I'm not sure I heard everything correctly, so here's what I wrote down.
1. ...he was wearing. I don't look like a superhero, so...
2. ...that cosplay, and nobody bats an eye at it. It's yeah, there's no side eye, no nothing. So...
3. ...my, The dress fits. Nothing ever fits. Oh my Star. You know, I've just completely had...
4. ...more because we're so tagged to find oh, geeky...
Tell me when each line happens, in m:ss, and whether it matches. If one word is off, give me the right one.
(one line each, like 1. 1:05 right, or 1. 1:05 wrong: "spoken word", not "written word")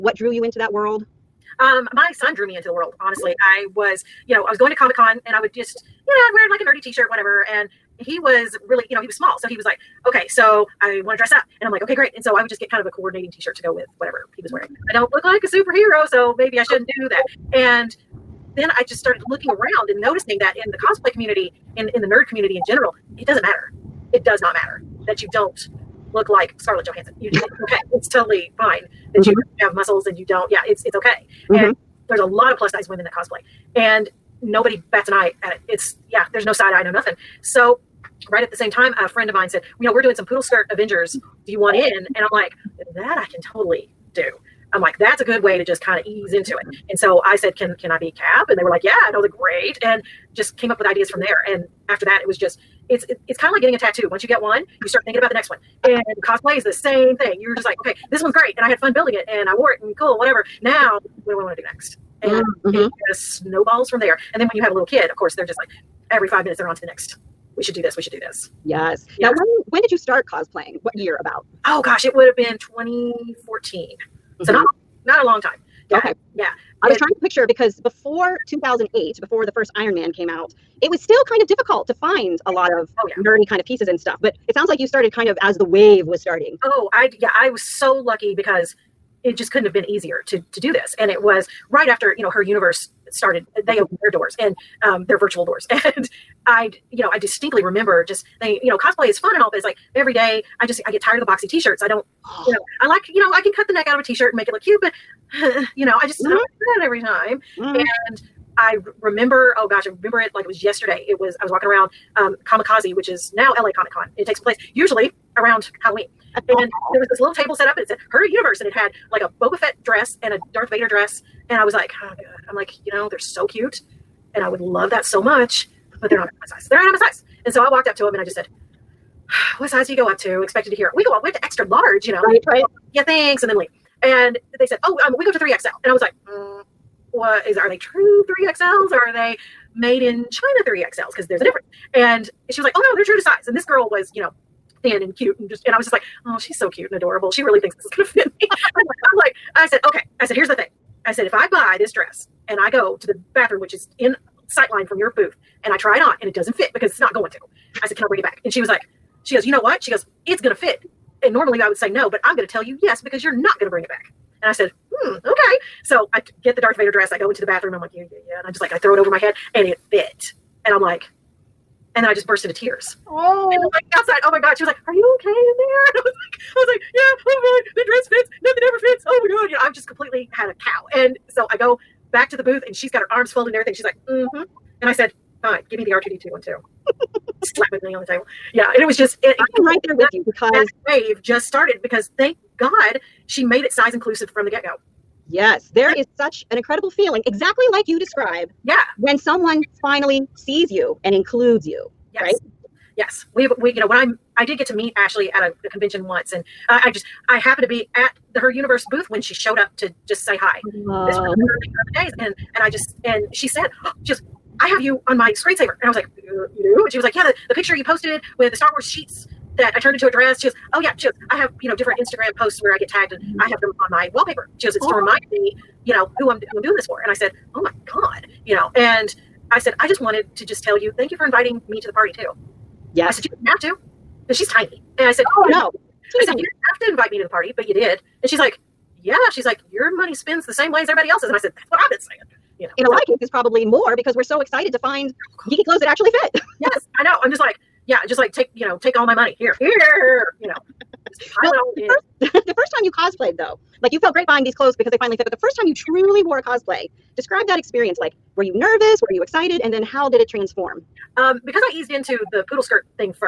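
1. 0:14 right
2. 0:33 right
3. 2:57 wrong: "God", not "Star"
4. 4:03 wrong: "excited", not "tagged".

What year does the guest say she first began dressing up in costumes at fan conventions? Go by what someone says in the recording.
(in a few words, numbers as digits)
2014.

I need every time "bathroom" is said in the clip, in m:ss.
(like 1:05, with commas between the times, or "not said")
2:33, 2:47.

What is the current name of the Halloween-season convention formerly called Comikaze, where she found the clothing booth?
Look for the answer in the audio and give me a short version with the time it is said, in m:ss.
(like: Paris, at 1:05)
LA Comic Con, at 1:53.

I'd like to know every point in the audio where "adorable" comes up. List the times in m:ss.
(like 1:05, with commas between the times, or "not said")
2:26.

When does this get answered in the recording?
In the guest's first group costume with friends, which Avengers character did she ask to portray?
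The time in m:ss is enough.
0:48.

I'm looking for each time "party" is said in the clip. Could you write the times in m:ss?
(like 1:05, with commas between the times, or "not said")
3:51, 3:57.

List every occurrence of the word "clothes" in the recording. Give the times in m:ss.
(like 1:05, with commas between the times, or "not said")
4:05, 4:14.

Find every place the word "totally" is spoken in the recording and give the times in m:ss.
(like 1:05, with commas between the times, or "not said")
0:28, 0:43.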